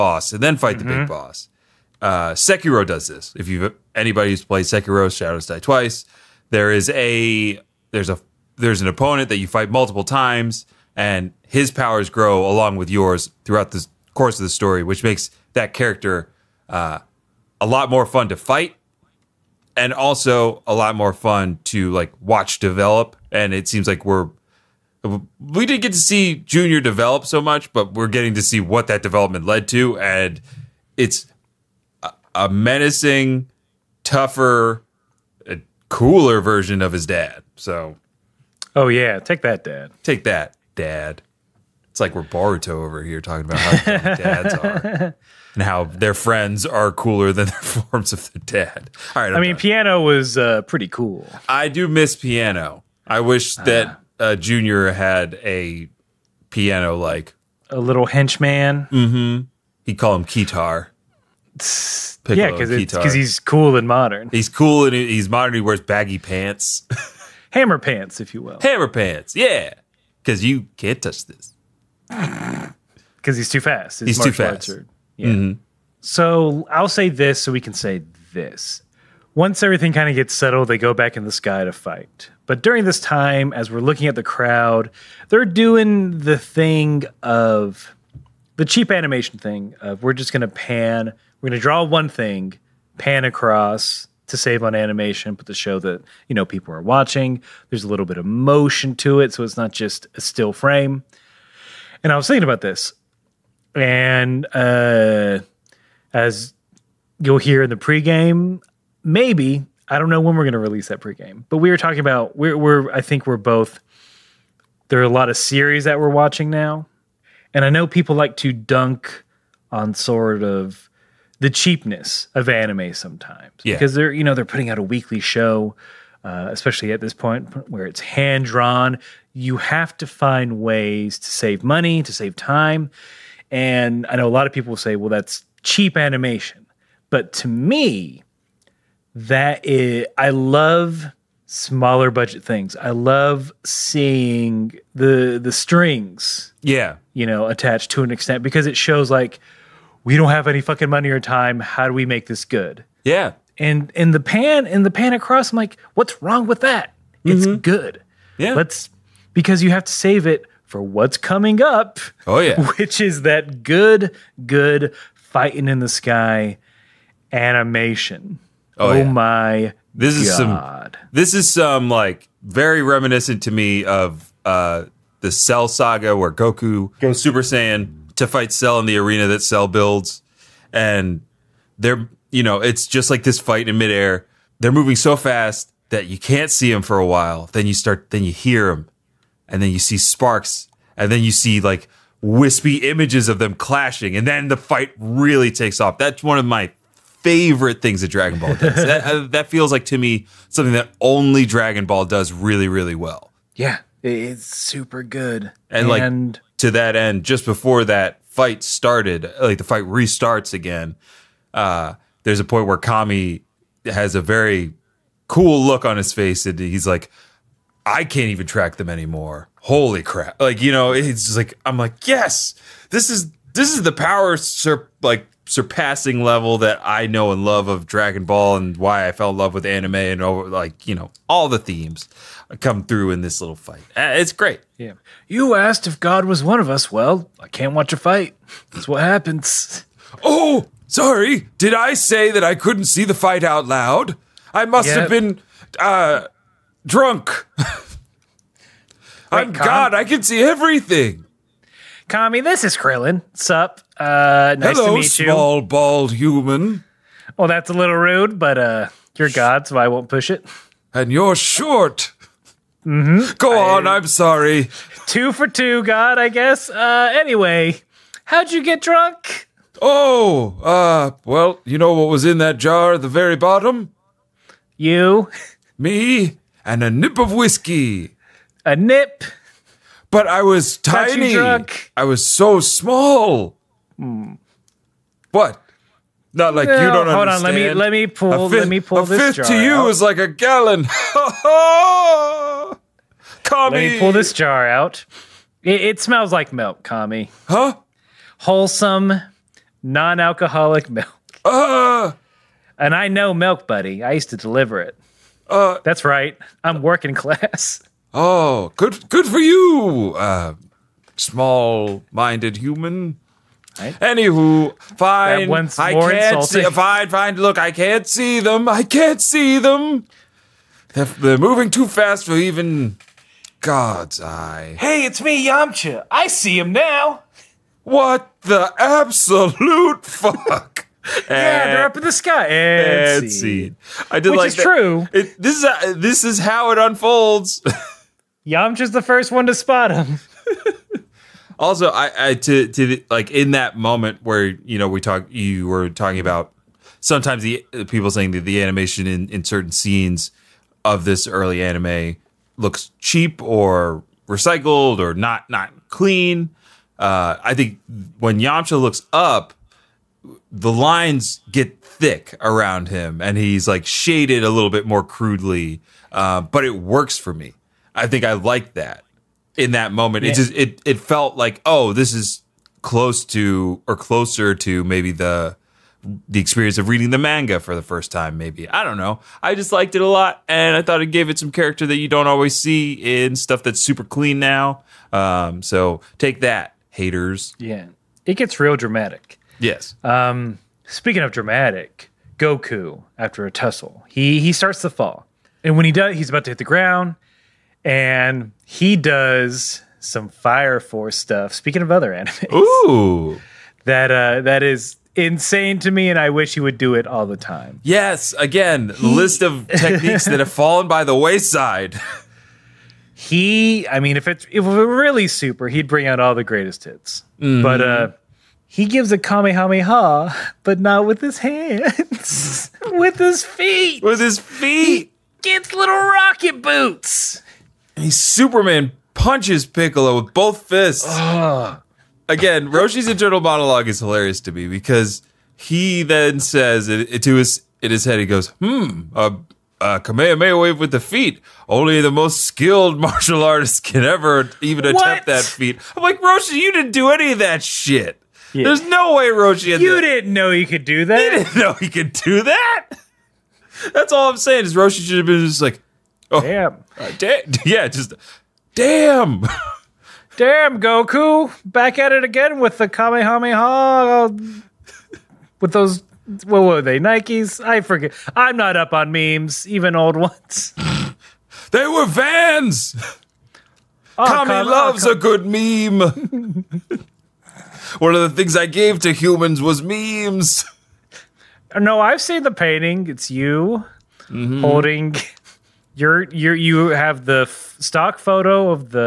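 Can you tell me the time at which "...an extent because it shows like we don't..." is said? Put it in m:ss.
2:28.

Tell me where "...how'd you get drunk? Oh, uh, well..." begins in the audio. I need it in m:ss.
4:28.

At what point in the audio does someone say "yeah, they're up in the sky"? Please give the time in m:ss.
5:31.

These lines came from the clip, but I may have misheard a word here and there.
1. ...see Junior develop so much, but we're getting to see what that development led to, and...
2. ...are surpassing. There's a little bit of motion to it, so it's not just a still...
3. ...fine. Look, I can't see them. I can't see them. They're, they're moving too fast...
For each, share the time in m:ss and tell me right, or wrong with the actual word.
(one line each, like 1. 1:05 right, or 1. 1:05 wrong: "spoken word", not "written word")
1. 0:25 right
2. 1:36 wrong: "watching", not "surpassing"
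3. 5:17 right.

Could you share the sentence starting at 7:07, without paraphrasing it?
And he Superman punches Piccolo with both fists.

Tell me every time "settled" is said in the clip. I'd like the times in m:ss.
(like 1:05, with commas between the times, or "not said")
1:20.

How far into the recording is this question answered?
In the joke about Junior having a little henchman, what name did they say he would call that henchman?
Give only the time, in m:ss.
1:00.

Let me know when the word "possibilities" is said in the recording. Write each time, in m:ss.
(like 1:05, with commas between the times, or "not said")
not said.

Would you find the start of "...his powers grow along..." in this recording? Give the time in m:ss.
0:11.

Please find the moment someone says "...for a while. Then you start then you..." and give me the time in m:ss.
3:06.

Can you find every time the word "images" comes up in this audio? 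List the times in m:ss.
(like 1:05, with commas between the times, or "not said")
3:12.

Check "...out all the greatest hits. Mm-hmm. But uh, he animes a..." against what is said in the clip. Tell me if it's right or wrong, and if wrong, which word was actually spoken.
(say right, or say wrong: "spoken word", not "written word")
wrong: "gives", not "animes".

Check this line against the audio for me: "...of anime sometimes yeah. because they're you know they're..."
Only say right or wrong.
right.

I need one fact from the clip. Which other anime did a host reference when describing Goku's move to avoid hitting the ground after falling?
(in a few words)
Fire Force.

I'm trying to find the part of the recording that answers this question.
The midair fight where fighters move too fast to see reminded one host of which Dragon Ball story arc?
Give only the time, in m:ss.
2:55.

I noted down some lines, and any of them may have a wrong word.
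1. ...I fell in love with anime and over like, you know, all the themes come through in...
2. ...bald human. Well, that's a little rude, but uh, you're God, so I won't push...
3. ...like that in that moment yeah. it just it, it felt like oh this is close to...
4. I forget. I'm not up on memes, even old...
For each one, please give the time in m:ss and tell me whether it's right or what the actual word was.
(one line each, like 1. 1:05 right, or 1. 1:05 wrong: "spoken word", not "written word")
1. 3:49 right
2. 4:15 right
3. 6:08 right
4. 7:47 right.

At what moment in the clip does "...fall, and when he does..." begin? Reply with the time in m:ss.
6:34.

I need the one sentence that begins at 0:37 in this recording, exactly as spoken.
So, oh yeah, take that, Dad.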